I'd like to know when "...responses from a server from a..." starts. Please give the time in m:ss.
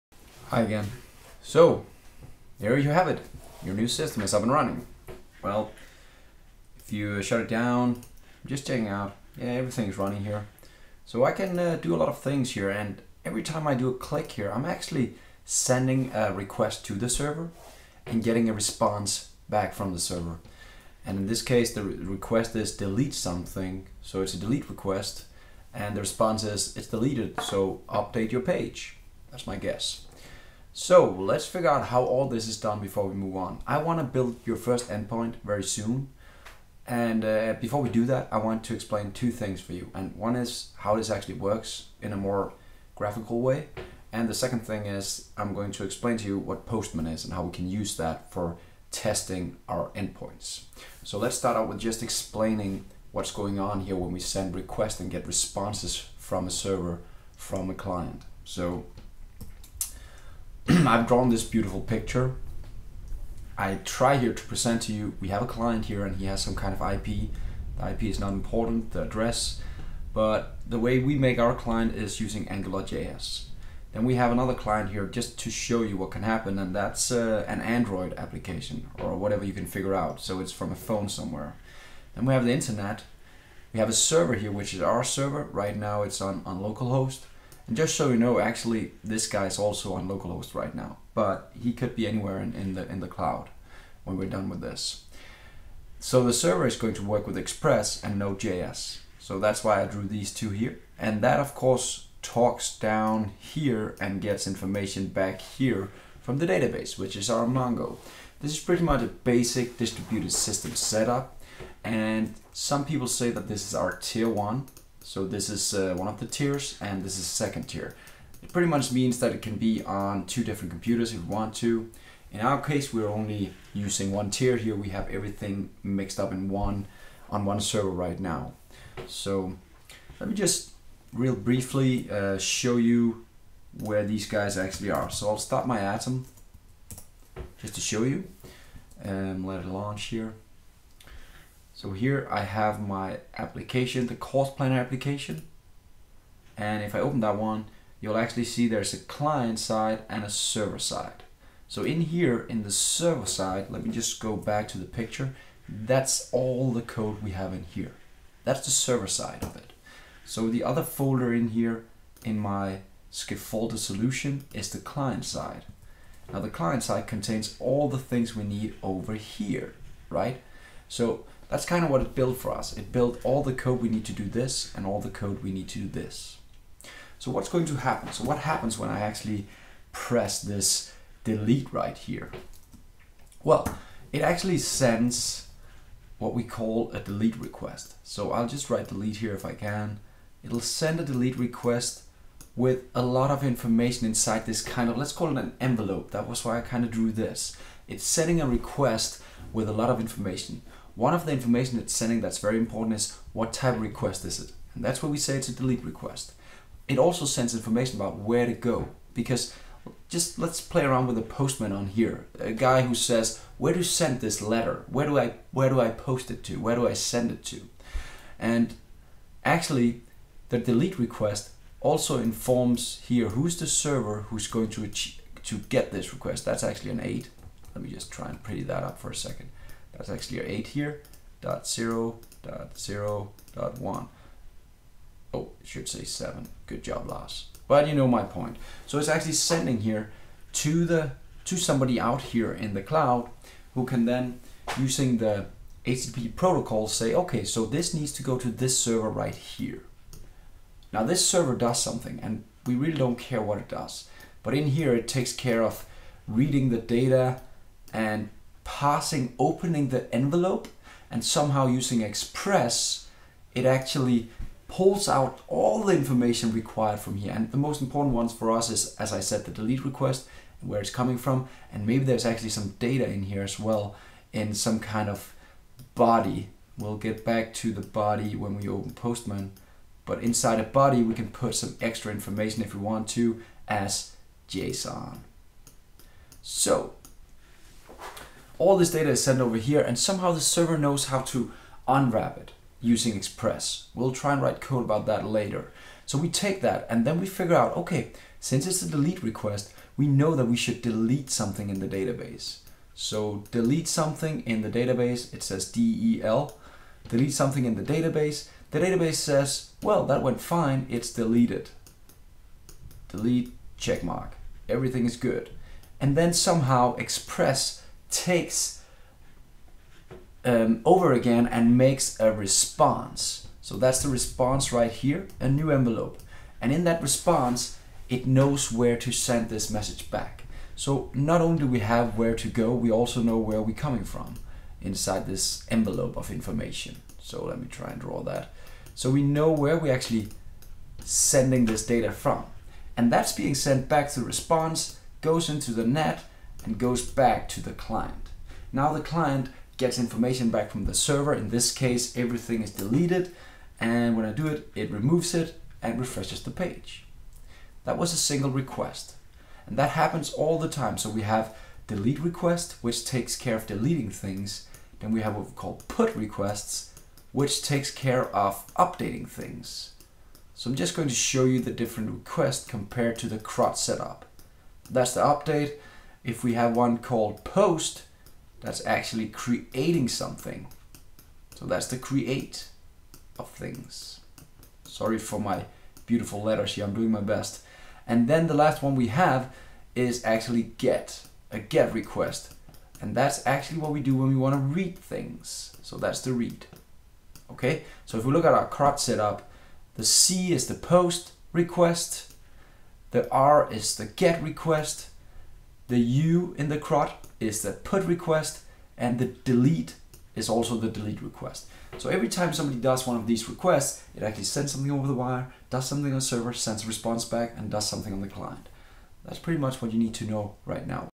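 0:55.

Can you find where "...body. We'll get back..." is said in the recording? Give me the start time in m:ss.
4:35.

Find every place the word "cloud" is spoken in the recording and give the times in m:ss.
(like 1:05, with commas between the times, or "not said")
1:33, 4:02.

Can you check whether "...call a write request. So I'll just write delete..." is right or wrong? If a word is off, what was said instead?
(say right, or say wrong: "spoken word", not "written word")
wrong: "delete", not "write".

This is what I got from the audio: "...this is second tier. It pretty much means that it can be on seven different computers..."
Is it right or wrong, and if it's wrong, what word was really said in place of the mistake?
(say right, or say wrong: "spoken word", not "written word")
wrong: "two", not "seven".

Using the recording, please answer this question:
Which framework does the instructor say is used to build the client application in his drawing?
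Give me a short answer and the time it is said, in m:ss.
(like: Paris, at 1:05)
AngularJS, at 1:12.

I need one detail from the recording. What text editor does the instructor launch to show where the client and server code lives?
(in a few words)
Atom.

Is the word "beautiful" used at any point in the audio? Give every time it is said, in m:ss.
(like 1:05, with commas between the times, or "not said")
1:01, 6:26.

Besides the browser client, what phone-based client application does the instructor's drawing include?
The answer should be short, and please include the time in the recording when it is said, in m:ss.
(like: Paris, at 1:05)
Android application, at 1:17.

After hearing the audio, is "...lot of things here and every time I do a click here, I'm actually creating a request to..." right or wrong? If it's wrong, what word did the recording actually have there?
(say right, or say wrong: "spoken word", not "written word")
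wrong: "sending", not "creating".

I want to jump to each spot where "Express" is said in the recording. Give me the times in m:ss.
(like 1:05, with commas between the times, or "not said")
1:37, 4:22, 4:53, 5:16.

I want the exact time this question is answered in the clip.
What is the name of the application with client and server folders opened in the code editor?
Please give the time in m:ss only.
2:24.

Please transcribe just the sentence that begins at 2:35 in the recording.
That's all the code we have in here.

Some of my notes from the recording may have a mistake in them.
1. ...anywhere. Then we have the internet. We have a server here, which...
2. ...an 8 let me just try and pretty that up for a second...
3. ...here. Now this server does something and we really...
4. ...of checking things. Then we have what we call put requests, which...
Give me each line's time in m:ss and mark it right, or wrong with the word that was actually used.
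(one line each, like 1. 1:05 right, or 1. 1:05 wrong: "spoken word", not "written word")
1. 1:21 wrong: "somewhere", not "anywhere"
2. 3:46 right
3. 4:09 right
4. 6:03 wrong: "deleting", not "checking".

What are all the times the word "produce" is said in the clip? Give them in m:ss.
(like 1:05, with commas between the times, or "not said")
not said.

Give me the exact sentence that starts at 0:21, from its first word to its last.
And in this case, the request is delete something.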